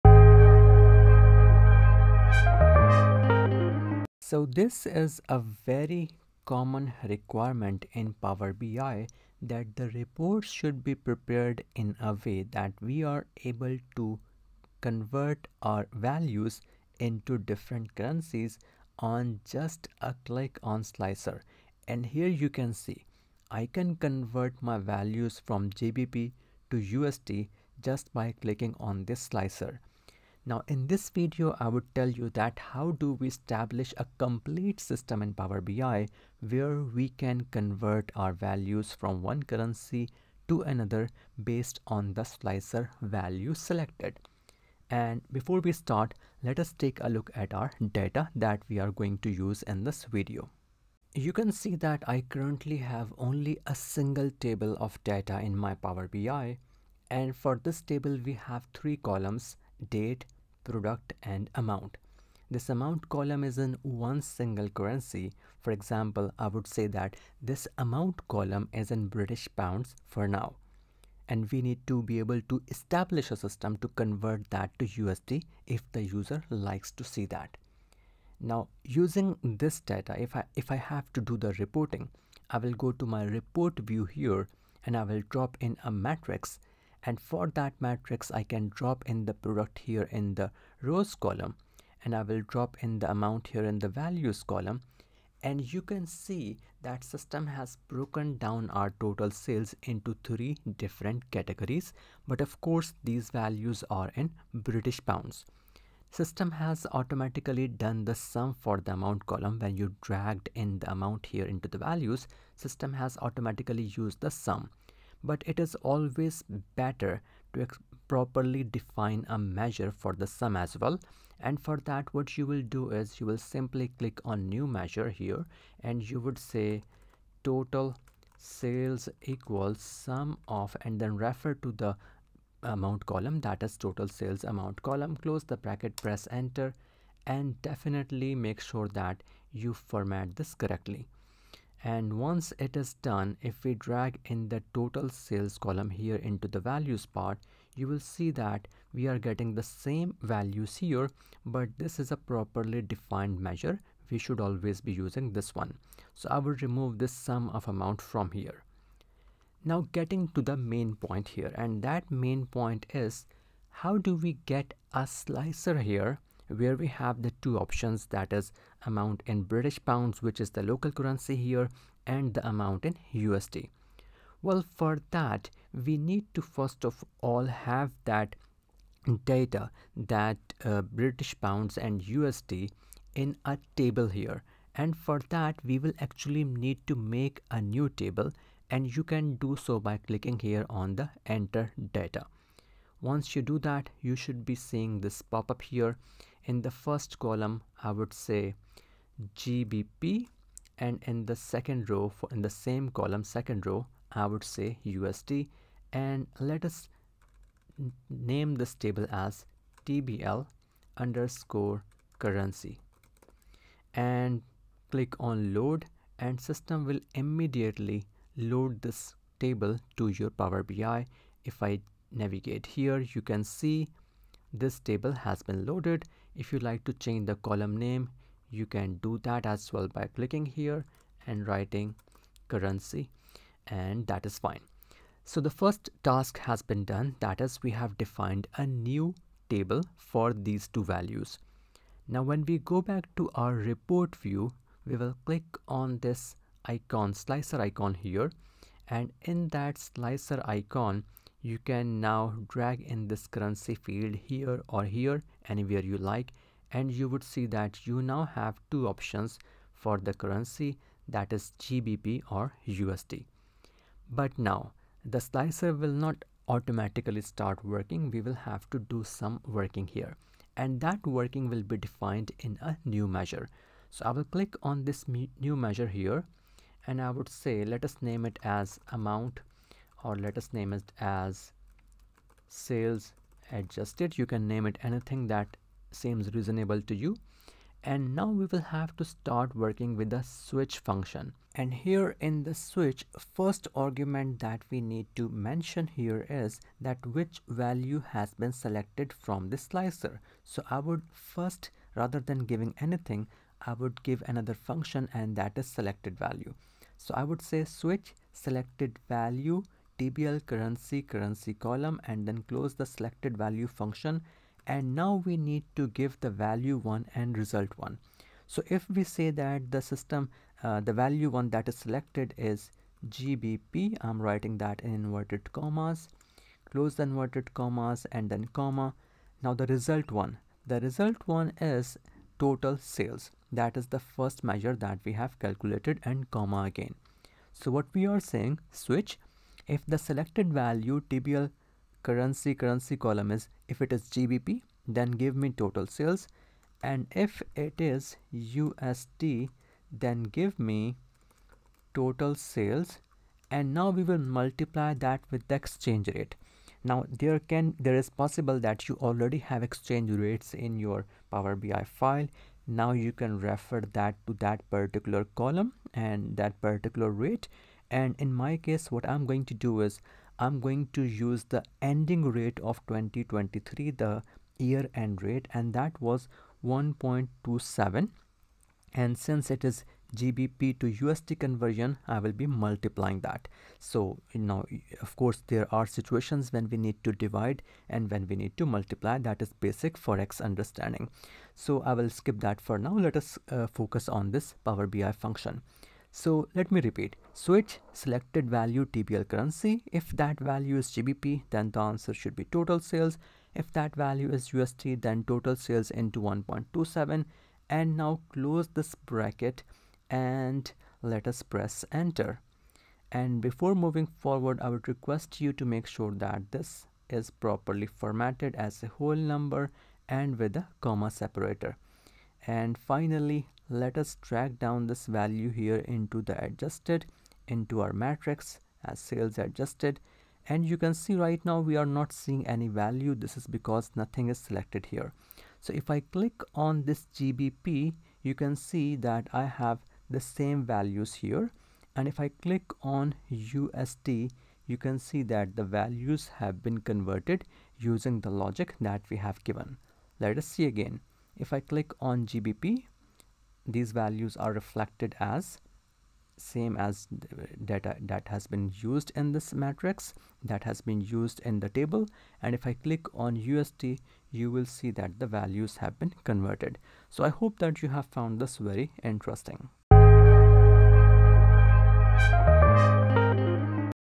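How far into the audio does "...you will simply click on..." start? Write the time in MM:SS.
02:03.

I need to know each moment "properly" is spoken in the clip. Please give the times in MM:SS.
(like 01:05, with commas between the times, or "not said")
01:58, 02:32, 06:57.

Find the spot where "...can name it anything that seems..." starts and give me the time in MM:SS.
04:44.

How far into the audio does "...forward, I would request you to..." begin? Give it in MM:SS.
06:54.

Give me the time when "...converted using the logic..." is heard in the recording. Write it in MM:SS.
07:26.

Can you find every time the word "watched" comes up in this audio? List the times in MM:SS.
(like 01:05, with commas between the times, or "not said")
not said.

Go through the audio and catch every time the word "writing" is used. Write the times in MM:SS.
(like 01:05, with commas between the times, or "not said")
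03:51, 05:24.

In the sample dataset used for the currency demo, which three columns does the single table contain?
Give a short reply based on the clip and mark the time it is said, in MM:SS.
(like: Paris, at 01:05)
date, product and amount, at 00:59.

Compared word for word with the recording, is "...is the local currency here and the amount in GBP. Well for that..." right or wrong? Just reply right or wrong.
wrong.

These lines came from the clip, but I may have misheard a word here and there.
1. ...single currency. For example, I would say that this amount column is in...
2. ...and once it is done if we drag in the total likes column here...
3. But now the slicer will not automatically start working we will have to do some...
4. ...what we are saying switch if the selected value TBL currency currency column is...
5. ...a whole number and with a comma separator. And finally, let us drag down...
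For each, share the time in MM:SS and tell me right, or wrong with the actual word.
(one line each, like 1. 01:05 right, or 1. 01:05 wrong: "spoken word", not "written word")
1. 01:04 right
2. 02:21 wrong: "sales", not "likes"
3. 04:24 right
4. 05:37 right
5. 06:58 right.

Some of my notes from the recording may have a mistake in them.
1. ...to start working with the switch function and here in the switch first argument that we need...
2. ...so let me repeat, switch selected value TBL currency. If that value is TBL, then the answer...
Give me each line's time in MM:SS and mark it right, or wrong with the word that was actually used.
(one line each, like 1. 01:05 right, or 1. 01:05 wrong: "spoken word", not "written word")
1. 04:48 right
2. 06:36 wrong: "GBP", not "TBL".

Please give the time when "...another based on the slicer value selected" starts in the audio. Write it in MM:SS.
00:40.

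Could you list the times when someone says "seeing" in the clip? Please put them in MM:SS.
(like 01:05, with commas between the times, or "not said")
03:14, 07:12.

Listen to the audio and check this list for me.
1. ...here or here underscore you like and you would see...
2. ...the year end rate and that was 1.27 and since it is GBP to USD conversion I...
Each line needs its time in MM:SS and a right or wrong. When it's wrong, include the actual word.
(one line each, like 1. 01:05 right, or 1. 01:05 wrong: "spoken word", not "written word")
1. 04:14 wrong: "anywhere", not "underscore"
2. 06:13 right.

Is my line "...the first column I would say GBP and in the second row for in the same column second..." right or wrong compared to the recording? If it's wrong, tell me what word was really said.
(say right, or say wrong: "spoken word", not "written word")
right.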